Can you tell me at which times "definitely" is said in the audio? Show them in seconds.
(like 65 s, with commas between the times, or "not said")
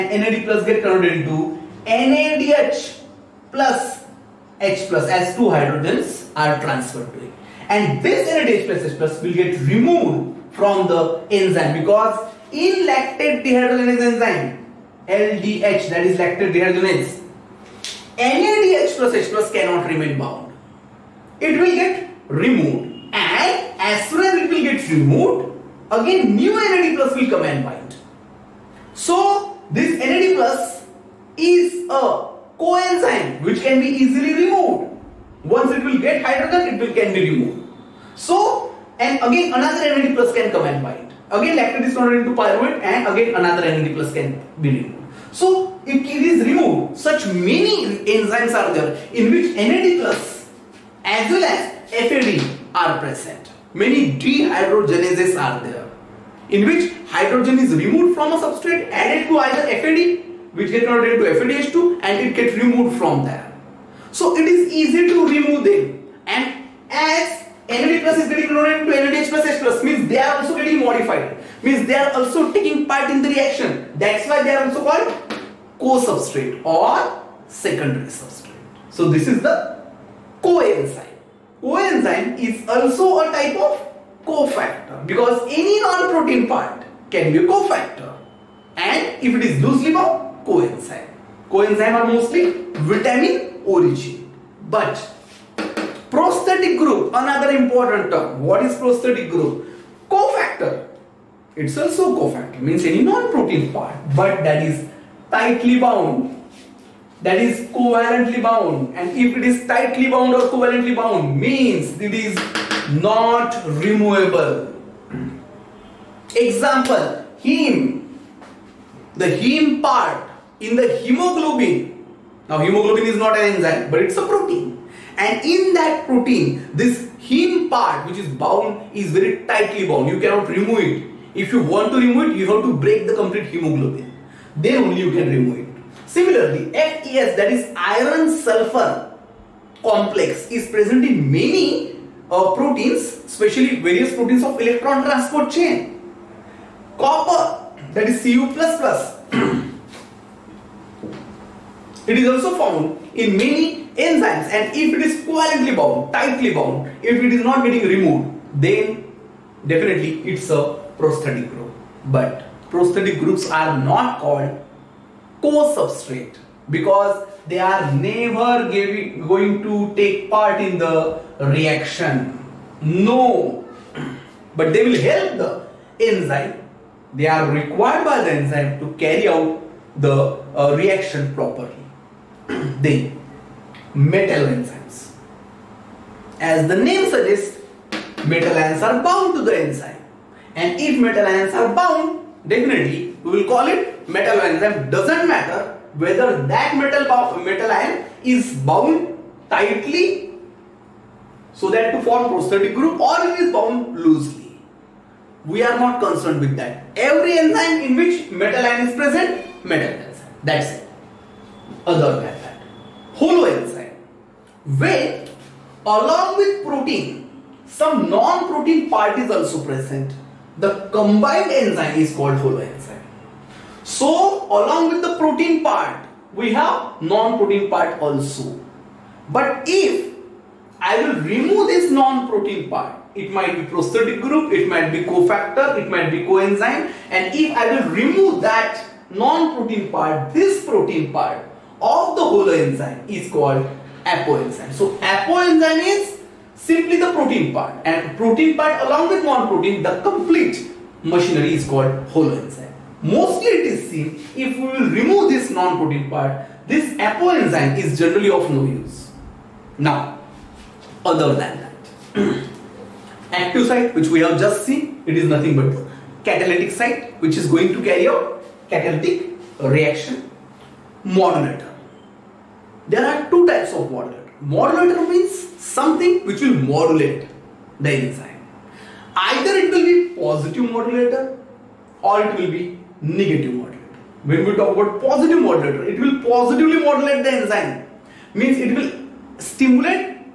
159 s, 192 s.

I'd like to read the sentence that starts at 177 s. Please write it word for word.
They are required by the enzyme to carry out the uh, reaction properly the metalloenzymes.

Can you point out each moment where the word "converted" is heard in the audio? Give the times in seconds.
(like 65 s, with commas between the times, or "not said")
0 s, 41 s, 60 s, 68 s.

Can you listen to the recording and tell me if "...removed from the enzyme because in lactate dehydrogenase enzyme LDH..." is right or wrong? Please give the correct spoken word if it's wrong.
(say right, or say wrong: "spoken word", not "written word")
right.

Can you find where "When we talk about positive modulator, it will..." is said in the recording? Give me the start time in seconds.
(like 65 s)
284 s.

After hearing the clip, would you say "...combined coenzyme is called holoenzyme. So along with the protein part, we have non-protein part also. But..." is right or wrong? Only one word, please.
wrong.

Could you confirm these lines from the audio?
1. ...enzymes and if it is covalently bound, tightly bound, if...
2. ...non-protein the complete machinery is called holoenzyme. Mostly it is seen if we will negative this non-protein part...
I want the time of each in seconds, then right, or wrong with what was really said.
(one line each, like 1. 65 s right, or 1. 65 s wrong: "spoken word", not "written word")
1. 153 s right
2. 249 s wrong: "remove", not "negative".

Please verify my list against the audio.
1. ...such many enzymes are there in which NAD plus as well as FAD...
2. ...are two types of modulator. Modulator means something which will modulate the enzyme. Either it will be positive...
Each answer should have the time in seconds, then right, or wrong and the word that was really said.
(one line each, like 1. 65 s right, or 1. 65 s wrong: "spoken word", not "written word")
1. 47 s right
2. 273 s right.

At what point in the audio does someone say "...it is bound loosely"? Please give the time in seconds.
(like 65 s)
203 s.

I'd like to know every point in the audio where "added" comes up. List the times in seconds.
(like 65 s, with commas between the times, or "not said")
59 s.